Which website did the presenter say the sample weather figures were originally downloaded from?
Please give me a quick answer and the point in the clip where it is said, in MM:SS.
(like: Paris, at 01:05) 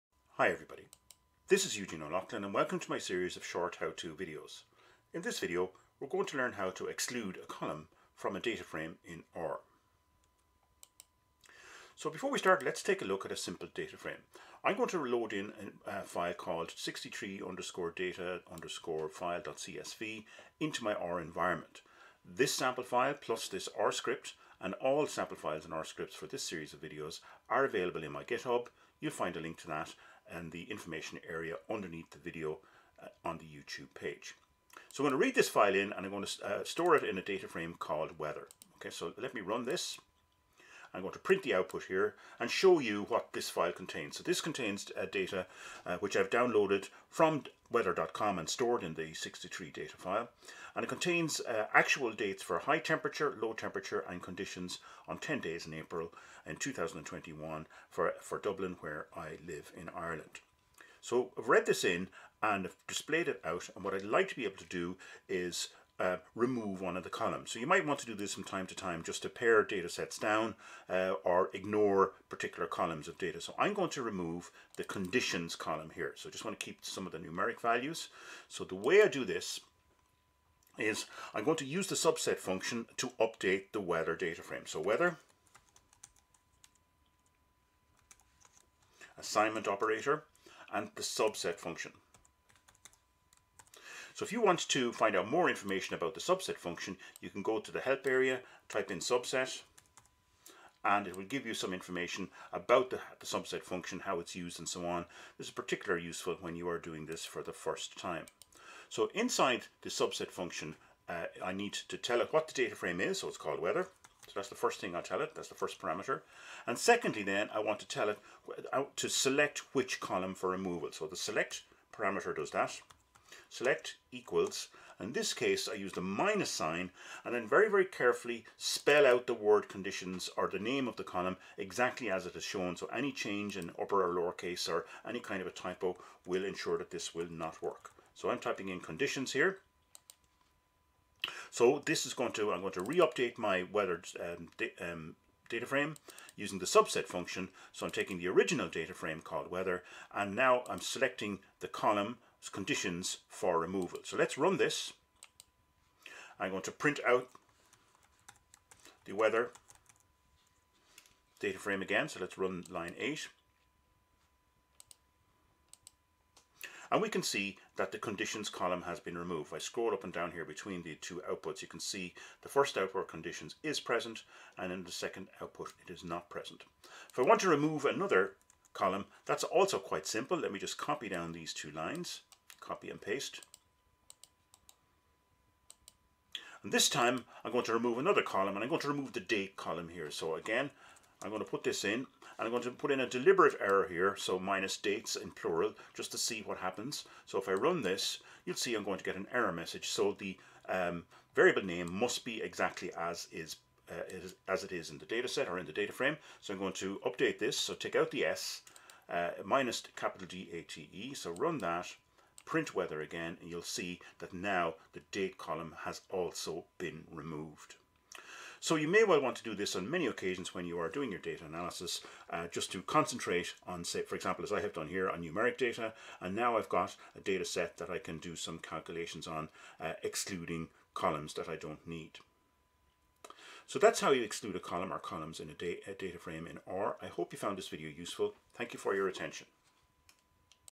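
weather.com, at 00:47.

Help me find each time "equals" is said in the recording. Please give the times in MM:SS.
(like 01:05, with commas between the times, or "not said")
02:04.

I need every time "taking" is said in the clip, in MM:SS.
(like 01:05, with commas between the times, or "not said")
02:27.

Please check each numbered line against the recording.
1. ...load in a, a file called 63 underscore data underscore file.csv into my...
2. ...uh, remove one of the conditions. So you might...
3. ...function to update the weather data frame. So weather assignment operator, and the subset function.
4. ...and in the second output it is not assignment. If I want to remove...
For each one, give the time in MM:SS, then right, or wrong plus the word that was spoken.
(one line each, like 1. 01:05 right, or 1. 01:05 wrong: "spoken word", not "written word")
1. 00:15 right
2. 01:06 wrong: "columns", not "conditions"
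3. 01:22 right
4. 02:54 wrong: "present", not "assignment".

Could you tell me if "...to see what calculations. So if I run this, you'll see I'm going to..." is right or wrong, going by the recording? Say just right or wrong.
wrong.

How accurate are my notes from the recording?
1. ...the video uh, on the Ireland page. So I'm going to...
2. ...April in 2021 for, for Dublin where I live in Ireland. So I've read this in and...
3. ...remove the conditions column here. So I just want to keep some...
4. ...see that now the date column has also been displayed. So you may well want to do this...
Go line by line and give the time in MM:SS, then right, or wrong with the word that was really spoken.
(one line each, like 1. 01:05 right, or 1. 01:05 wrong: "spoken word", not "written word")
1. 00:32 wrong: "YouTube", not "Ireland"
2. 00:55 right
3. 01:14 right
4. 03:33 wrong: "removed", not "displayed".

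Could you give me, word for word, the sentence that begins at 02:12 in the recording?
So any change in upper or lower case or any kind of a typo will ensure that this will not work.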